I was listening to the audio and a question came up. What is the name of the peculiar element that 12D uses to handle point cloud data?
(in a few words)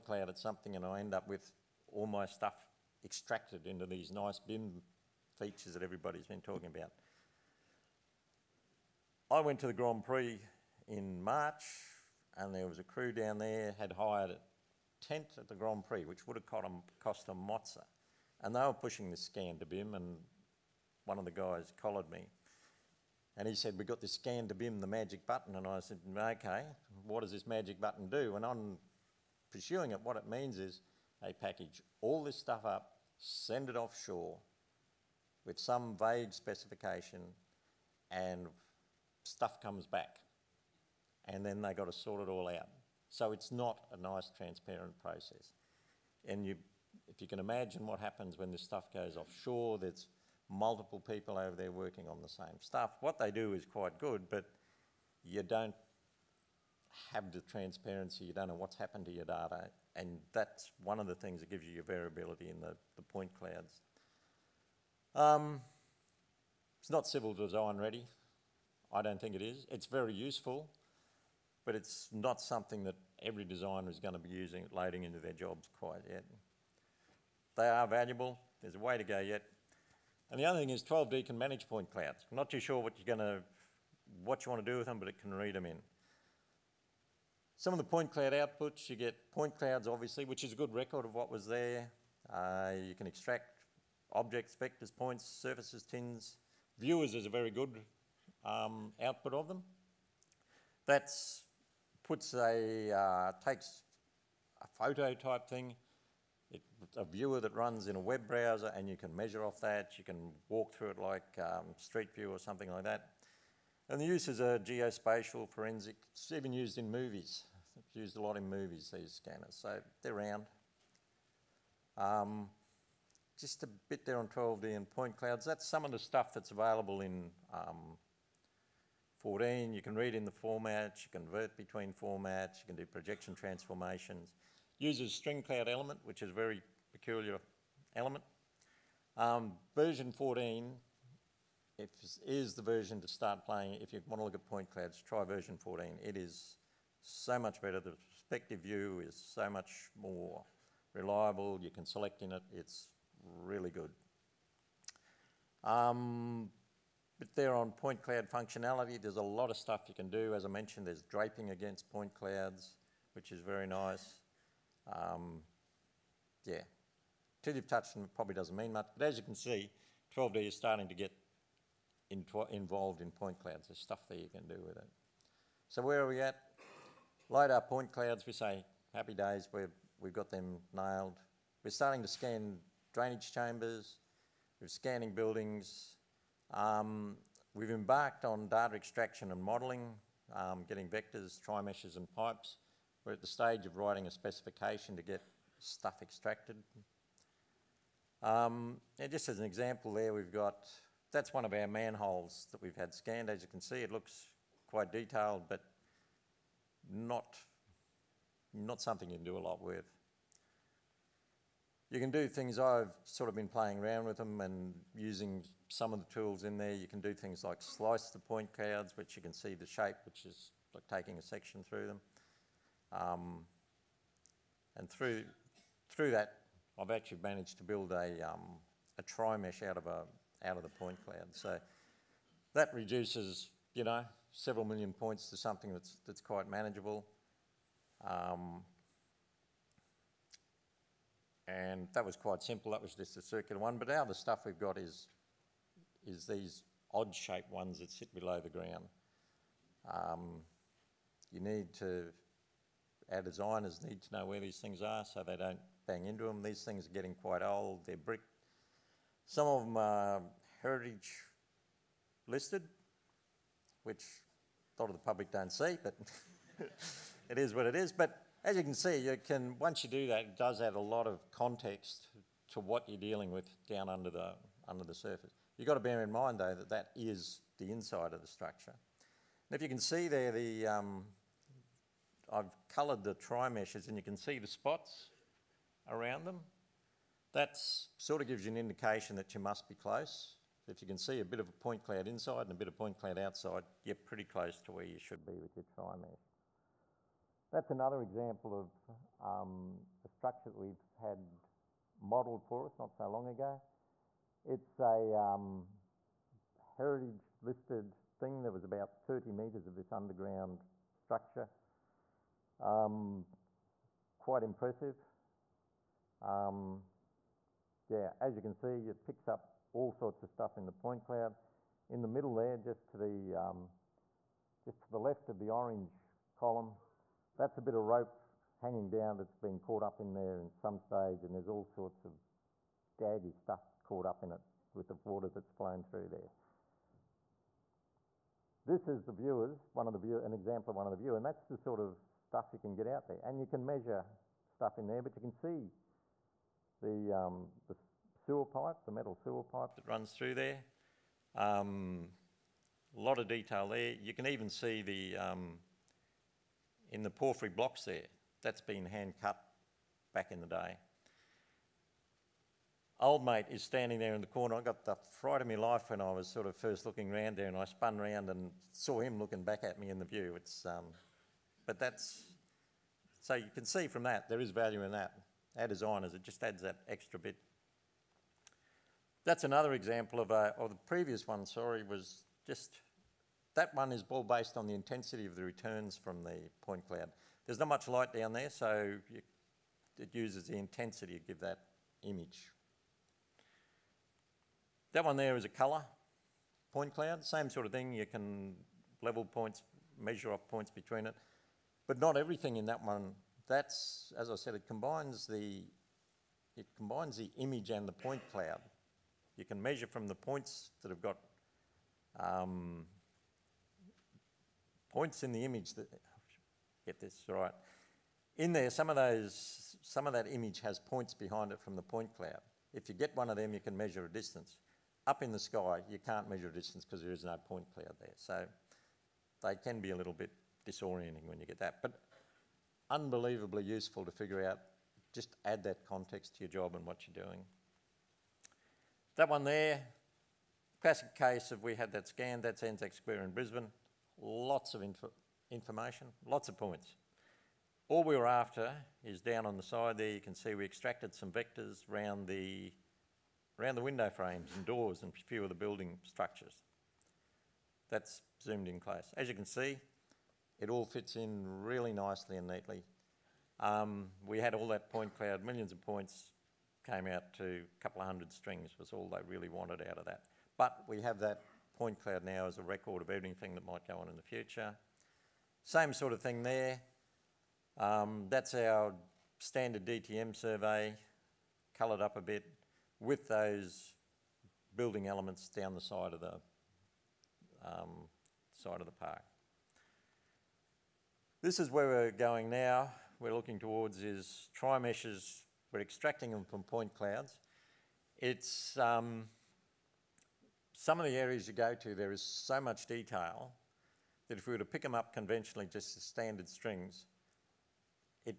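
String cloud element.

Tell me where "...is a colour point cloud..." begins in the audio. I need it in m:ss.
6:35.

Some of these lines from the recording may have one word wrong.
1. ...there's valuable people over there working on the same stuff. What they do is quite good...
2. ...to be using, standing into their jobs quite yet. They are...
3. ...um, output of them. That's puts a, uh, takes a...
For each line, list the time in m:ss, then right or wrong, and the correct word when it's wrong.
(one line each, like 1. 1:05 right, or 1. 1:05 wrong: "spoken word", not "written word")
1. 0:49 wrong: "multiple", not "valuable"
2. 1:14 wrong: "loading", not "standing"
3. 1:38 right.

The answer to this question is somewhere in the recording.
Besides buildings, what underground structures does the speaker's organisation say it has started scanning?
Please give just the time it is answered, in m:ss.
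3:02.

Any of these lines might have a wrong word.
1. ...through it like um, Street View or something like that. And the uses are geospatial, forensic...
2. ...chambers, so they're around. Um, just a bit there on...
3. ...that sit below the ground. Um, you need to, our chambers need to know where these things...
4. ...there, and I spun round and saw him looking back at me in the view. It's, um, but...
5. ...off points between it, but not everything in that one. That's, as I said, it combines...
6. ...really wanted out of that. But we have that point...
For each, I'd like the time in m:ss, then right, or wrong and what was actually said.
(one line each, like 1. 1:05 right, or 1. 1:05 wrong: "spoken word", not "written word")
1. 1:50 right
2. 1:59 wrong: "scanners", not "chambers"
3. 4:07 wrong: "designers", not "chambers"
4. 6:07 right
5. 6:40 right
6. 7:49 right.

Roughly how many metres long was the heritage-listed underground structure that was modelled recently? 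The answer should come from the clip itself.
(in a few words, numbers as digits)
30 metres.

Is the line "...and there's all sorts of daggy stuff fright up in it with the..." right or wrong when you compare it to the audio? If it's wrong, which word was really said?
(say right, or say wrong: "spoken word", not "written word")
wrong: "caught", not "fright".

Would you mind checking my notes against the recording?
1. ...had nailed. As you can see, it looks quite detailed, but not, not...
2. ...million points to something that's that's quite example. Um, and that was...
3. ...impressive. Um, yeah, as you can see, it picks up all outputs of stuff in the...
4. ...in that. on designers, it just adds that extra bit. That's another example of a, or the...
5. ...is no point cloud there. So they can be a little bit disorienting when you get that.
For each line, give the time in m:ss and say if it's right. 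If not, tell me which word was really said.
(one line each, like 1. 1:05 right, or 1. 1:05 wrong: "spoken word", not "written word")
1. 3:22 wrong: "scanned", not "nailed"
2. 3:54 wrong: "manageable", not "example"
3. 5:14 wrong: "sorts", not "outputs"
4. 6:14 right
5. 7:07 right.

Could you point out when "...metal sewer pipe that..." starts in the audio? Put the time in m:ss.
5:48.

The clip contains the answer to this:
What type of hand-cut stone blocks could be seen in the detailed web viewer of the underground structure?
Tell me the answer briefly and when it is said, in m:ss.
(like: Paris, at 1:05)
Porphyry, at 5:57.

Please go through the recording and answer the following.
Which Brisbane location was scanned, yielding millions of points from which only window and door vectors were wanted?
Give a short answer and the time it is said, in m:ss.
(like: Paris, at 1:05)
Anzac Square, at 7:22.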